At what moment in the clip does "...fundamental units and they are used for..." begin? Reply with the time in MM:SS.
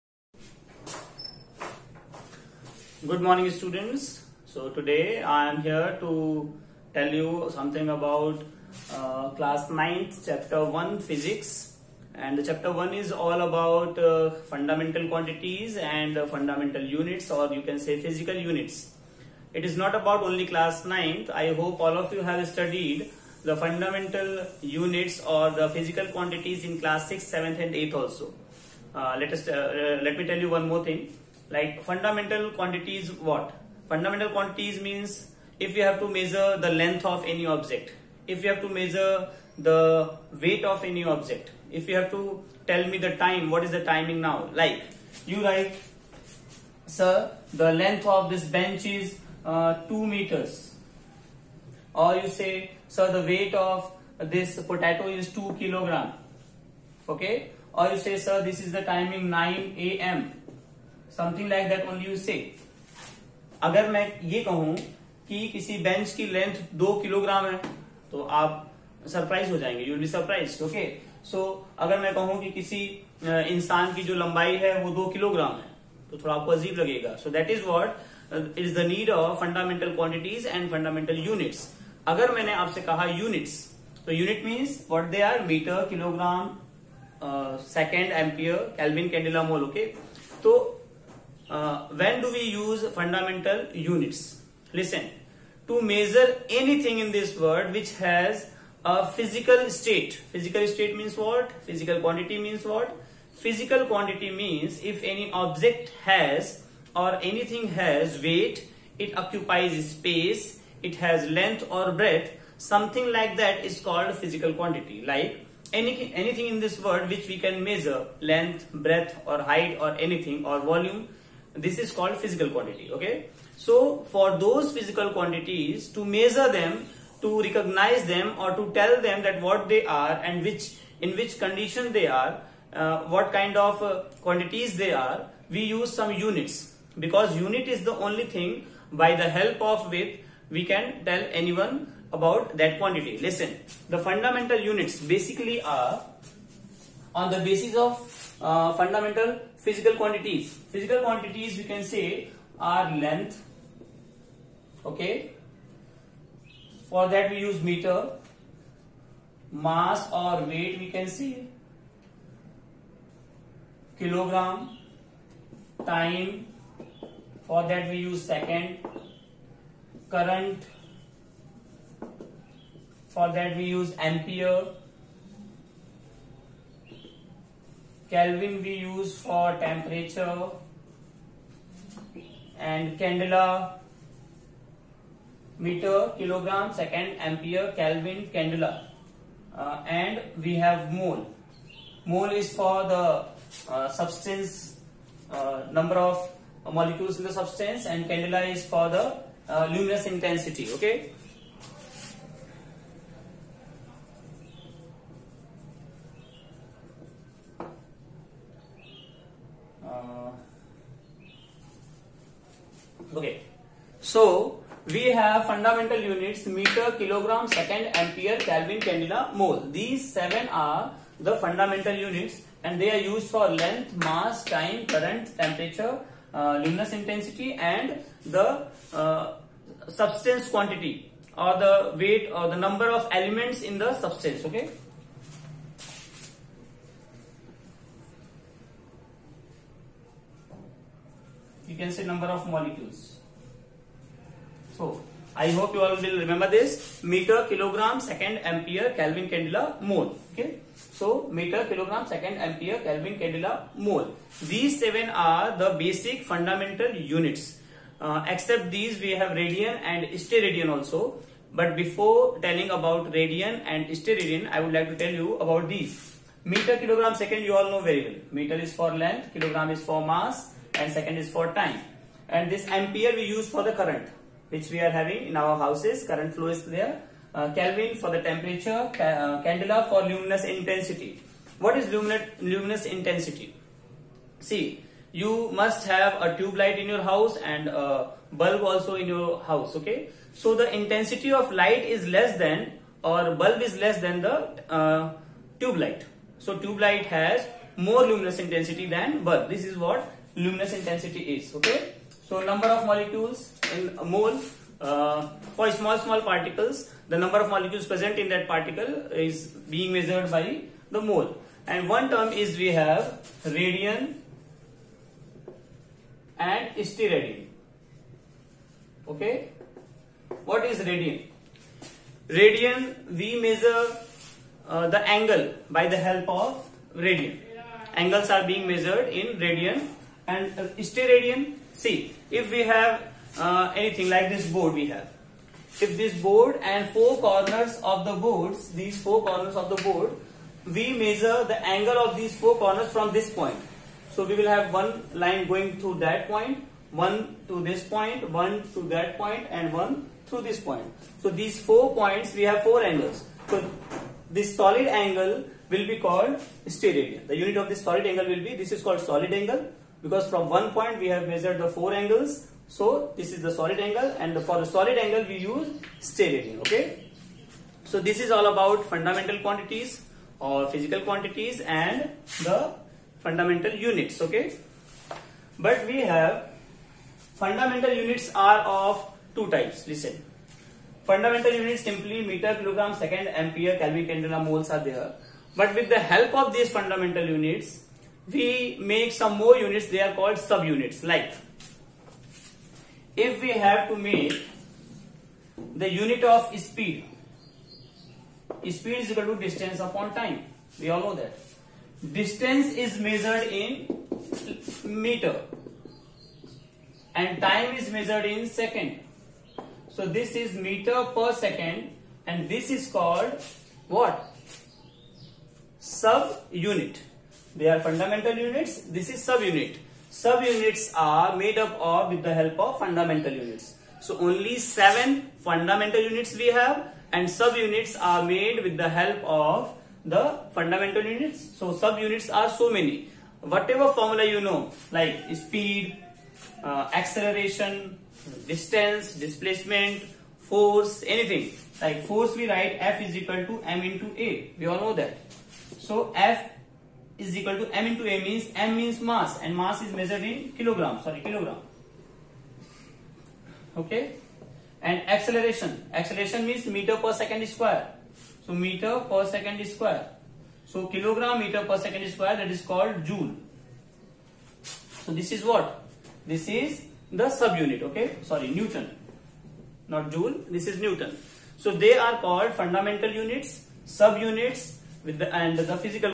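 03:41.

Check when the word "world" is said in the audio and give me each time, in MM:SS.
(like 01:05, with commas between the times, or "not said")
01:37, 01:56.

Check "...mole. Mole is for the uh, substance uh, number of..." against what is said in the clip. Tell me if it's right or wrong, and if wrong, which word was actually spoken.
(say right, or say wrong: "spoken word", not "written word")
right.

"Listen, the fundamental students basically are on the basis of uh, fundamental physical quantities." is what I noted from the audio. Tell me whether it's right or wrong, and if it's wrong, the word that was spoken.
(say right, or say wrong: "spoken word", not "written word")
wrong: "units", not "students".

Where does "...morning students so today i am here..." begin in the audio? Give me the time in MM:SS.
00:03.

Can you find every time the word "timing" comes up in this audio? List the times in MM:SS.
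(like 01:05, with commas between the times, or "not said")
00:43, 00:58.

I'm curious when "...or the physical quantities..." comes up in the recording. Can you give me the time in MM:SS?
00:25.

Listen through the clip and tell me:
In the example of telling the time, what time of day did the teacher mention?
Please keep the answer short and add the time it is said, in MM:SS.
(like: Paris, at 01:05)
9 a.m., at 00:59.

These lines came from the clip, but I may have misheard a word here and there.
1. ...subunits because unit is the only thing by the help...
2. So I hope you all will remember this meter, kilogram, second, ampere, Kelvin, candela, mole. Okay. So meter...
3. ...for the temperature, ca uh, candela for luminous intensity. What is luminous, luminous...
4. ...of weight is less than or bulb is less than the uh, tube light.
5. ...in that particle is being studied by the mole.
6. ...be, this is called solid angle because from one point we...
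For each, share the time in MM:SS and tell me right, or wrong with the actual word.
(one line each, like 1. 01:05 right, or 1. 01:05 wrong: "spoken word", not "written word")
1. 02:16 wrong: "units", not "subunits"
2. 04:04 right
3. 04:37 right
4. 04:51 wrong: "light", not "weight"
5. 05:08 wrong: "measured", not "studied"
6. 05:58 right.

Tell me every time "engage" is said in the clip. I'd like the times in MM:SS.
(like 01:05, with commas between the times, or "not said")
not said.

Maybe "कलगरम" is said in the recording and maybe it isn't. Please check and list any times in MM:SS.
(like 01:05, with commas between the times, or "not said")
01:07, 01:15, 01:25.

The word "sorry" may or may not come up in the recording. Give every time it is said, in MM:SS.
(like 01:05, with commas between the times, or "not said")
07:31, 07:48.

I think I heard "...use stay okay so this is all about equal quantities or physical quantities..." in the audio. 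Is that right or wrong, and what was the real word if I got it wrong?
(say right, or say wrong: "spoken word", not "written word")
wrong: "fundamental", not "equal".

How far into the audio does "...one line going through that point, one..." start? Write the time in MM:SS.
05:44.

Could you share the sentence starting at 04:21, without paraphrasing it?
But before telling about radian and steradian, I would like to tell you about these.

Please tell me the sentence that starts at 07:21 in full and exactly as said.
Like force we write F is equal to M into A.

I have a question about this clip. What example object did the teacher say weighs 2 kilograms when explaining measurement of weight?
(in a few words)
Potato.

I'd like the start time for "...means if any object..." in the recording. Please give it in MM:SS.
01:44.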